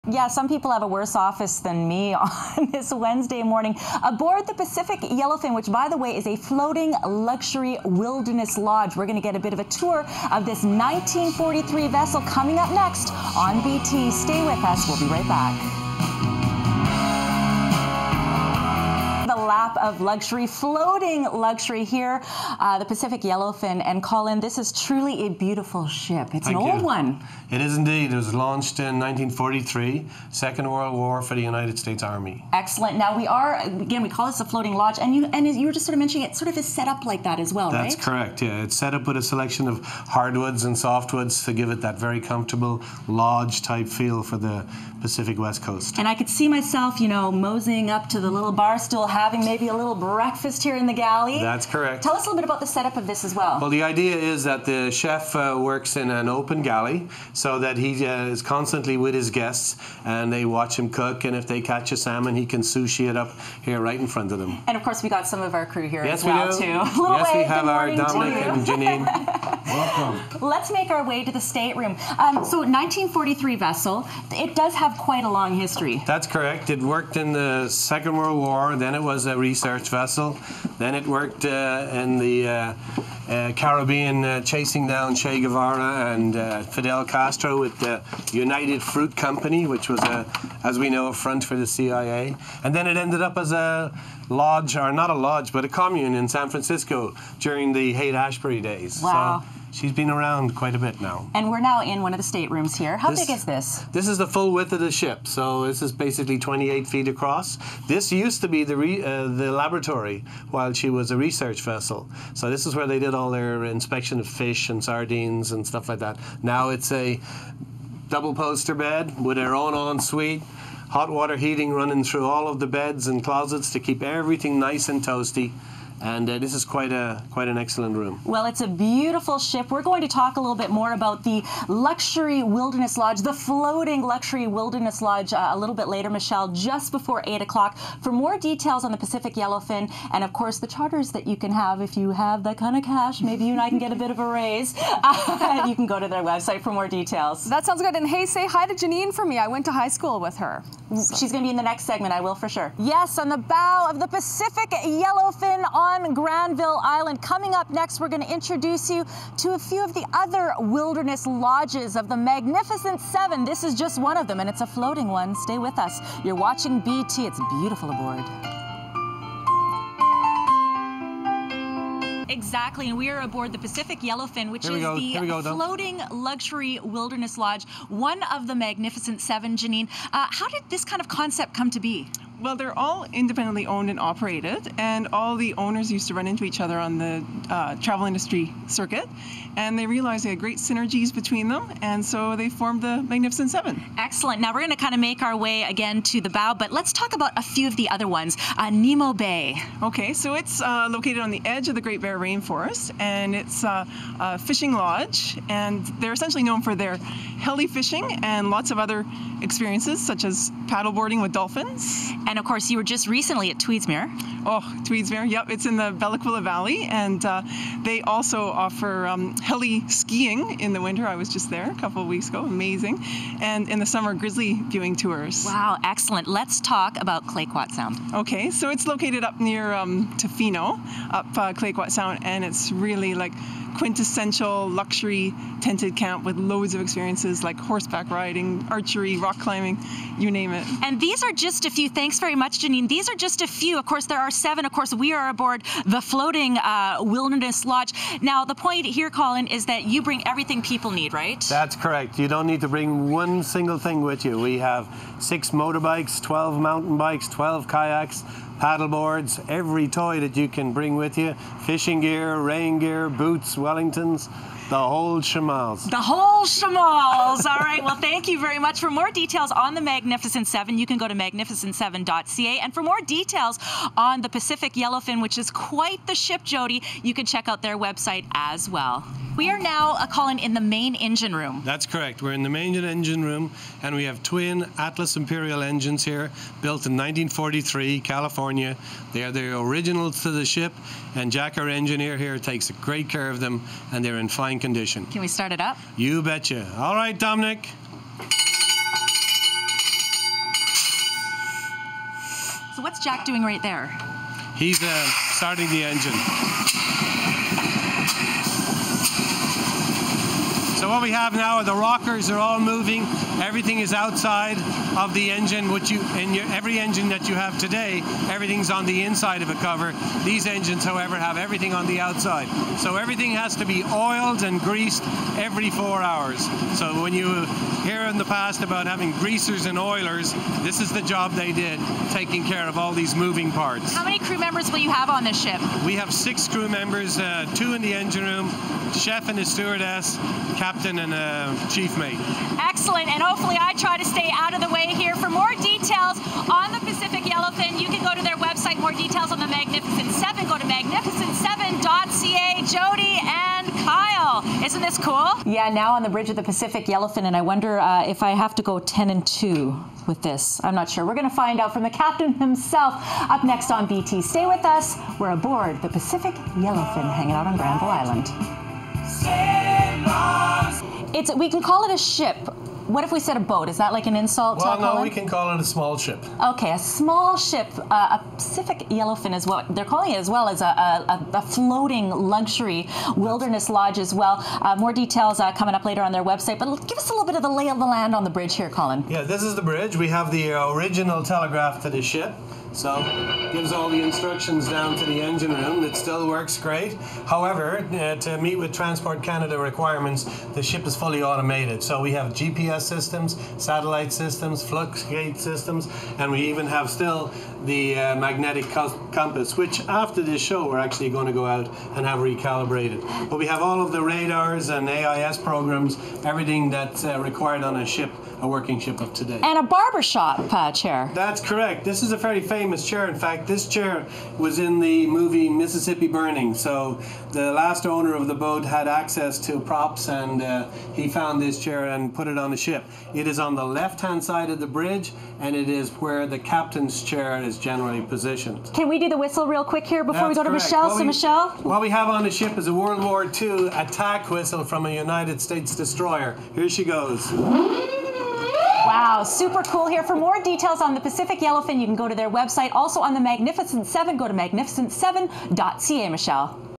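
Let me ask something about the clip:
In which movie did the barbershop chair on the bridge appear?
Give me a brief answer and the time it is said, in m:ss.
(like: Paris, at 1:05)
Mississippi Burning, at 7:05.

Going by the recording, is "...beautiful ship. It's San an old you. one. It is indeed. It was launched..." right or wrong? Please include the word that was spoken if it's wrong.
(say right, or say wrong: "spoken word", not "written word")
wrong: "Thank", not "San".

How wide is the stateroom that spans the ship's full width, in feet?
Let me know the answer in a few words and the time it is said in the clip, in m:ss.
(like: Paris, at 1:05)
28 feet, at 1:46.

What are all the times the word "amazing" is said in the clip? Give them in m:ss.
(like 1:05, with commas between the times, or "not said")
3:42.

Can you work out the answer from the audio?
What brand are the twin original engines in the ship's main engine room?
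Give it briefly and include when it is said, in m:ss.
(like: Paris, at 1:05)
Atlas Imperial, at 4:44.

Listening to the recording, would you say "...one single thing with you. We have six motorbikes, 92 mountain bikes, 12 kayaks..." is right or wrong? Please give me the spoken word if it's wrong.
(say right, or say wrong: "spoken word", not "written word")
wrong: "12", not "92".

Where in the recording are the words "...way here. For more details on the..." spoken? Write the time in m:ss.
5:44.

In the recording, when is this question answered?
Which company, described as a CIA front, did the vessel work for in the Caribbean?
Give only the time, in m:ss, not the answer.
1:28.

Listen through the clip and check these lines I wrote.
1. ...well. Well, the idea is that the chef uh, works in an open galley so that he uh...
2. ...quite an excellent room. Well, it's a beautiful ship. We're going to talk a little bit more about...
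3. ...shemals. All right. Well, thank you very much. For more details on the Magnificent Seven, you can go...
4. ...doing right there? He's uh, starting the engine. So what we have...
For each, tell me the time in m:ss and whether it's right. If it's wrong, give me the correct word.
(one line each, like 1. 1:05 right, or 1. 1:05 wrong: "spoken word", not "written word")
1. 0:53 right
2. 2:07 right
3. 4:26 right
4. 5:03 right.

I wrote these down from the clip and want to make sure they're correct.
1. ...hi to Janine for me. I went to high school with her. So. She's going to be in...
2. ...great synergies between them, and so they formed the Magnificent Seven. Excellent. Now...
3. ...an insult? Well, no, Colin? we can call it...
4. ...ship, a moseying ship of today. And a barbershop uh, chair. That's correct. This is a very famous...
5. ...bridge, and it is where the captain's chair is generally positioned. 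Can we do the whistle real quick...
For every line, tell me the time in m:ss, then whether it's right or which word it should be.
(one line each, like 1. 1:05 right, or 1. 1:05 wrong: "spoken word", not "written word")
1. 2:28 right
2. 3:10 right
3. 6:14 right
4. 6:57 wrong: "working", not "moseying"
5. 7:14 right.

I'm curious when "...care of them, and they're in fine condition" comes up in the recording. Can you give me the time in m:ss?
4:53.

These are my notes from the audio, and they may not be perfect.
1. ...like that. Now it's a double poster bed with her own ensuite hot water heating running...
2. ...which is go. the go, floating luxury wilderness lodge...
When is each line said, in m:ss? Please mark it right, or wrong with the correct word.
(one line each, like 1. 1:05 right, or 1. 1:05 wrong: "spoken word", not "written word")
1. 1:55 right
2. 2:54 right.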